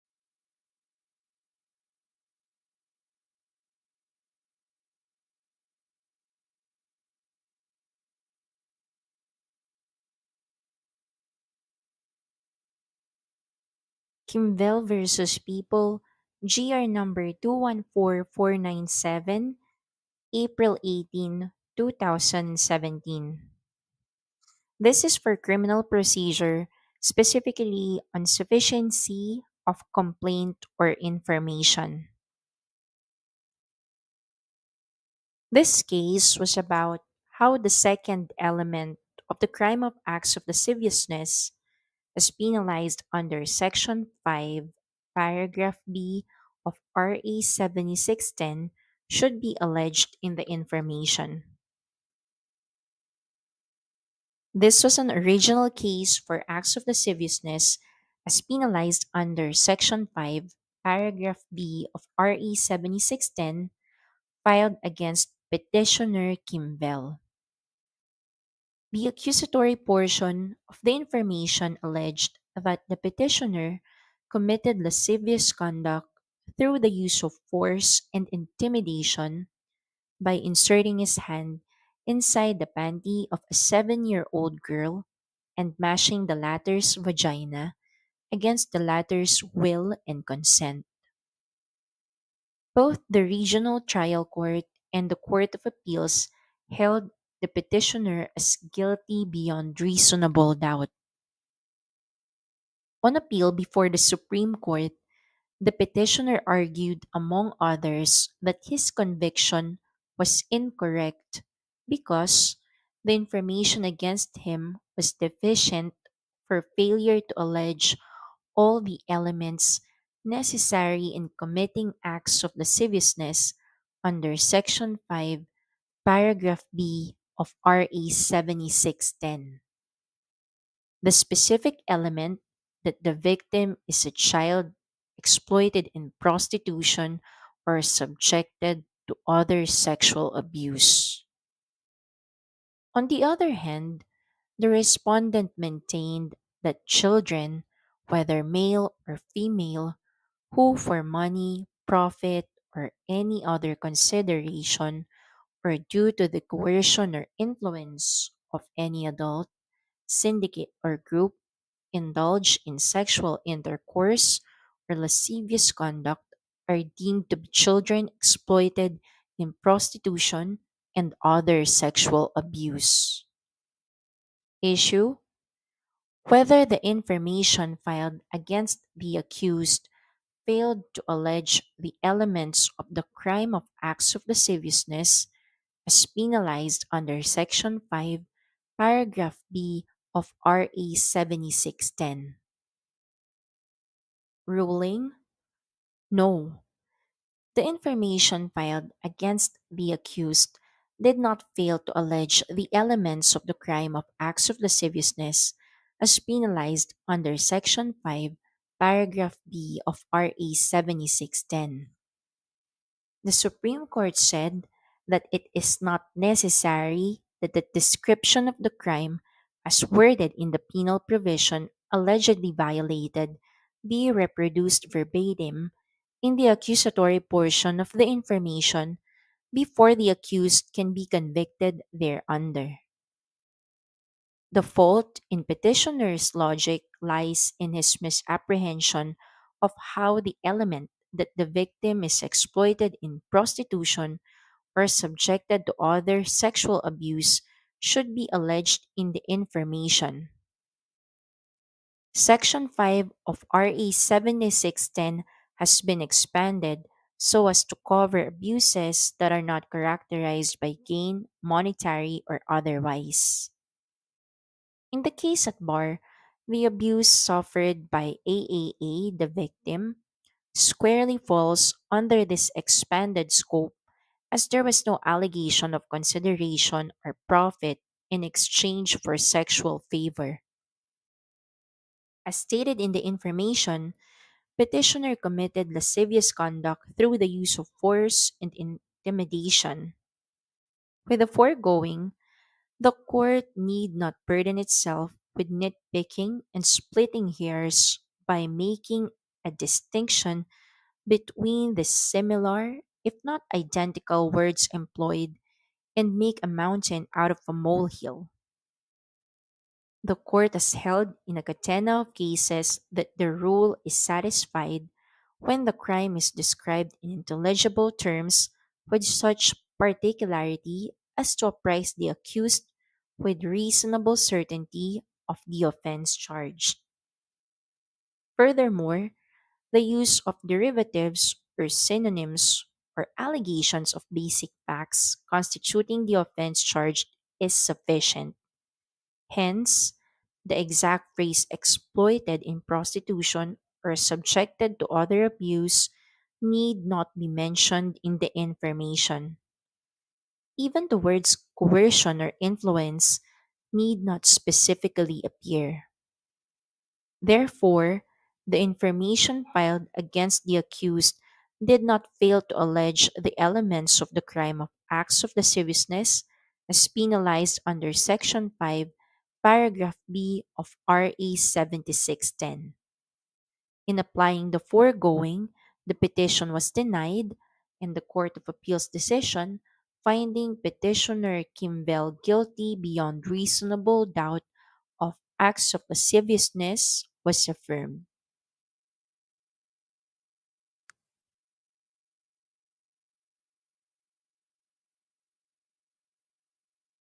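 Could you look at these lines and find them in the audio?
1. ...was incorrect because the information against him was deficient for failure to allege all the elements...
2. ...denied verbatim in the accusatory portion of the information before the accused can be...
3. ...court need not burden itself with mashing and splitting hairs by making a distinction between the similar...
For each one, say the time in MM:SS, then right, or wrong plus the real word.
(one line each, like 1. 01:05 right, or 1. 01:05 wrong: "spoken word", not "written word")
1. 01:50 right
2. 03:44 wrong: "reproduced", not "denied"
3. 04:52 wrong: "nitpicking", not "mashing".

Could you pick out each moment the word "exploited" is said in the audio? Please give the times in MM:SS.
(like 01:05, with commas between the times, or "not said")
02:15, 02:48, 04:02, 05:41.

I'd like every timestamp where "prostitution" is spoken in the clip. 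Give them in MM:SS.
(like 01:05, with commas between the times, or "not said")
02:16, 02:49, 04:03, 05:42.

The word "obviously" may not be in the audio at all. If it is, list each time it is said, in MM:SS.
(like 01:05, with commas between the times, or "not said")
not said.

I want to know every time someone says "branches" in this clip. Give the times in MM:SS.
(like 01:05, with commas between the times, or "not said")
not said.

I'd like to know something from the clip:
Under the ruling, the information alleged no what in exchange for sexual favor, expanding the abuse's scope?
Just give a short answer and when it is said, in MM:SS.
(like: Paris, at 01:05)
consideration or profit, at 04:35.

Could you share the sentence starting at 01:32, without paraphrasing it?
Both the Regional Trial Court and the Court of Appeals held the petitioner as guilty beyond reasonable doubt.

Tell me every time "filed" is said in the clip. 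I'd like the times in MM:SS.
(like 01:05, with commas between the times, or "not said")
01:04, 02:57, 03:18, 05:59.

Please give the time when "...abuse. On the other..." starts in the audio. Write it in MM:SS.
02:20.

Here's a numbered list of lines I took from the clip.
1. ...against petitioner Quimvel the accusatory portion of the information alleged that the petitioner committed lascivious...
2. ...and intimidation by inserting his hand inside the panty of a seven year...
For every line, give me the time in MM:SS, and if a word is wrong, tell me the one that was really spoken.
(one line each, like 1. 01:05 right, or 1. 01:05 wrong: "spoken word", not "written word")
1. 01:04 right
2. 01:18 right.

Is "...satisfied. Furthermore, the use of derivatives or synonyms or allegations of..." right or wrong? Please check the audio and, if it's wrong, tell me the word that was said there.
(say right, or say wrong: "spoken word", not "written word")
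wrong: "charged", not "satisfied".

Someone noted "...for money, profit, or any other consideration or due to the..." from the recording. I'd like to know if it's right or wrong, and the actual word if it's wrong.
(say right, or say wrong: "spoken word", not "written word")
right.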